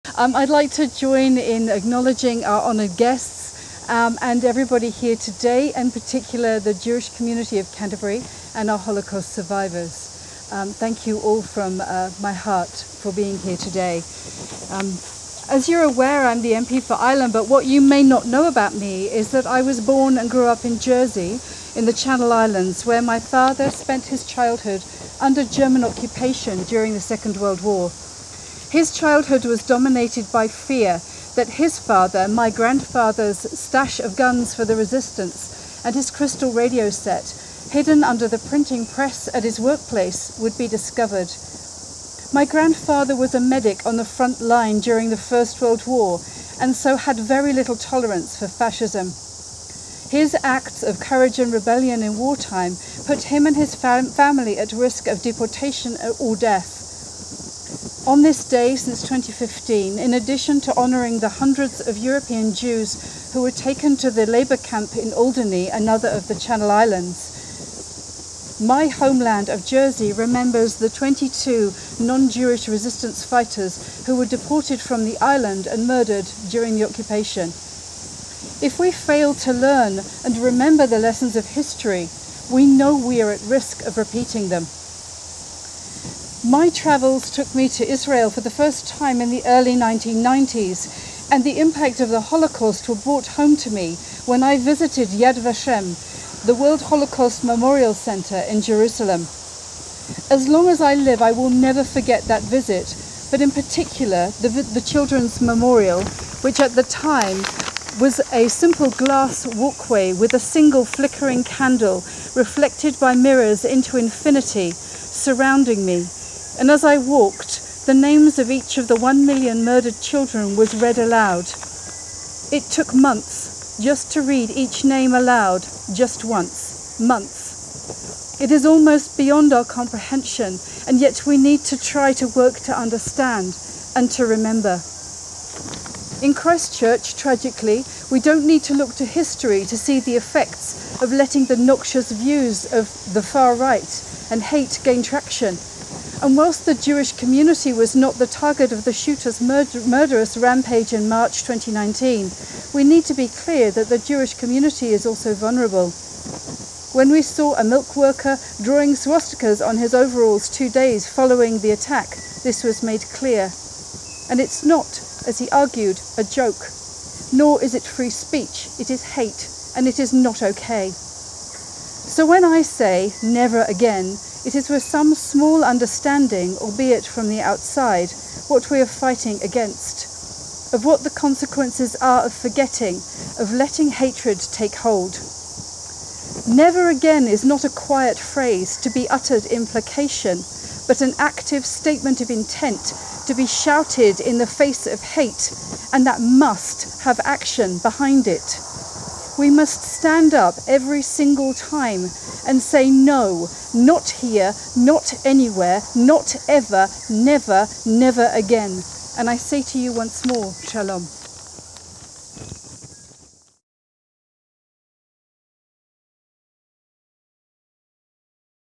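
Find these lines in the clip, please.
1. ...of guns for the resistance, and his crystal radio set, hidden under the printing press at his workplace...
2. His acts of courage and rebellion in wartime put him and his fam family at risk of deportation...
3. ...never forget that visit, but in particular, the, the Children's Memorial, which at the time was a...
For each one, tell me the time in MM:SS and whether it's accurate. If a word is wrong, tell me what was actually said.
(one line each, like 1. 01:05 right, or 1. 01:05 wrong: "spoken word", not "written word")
1. 00:33 right
2. 00:50 right
3. 01:41 right.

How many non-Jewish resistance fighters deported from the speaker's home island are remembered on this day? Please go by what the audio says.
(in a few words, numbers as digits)
22.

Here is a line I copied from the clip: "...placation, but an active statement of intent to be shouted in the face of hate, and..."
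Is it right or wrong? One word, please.
right.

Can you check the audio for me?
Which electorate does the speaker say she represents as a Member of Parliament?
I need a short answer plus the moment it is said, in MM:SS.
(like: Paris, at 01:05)
Ilam, at 00:16.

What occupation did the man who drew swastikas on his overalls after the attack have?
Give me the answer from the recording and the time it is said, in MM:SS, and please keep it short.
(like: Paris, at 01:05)
Milk worker, at 02:37.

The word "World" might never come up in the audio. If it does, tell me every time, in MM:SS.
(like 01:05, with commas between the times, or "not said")
00:27, 00:45, 01:36.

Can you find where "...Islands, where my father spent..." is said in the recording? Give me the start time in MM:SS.
00:22.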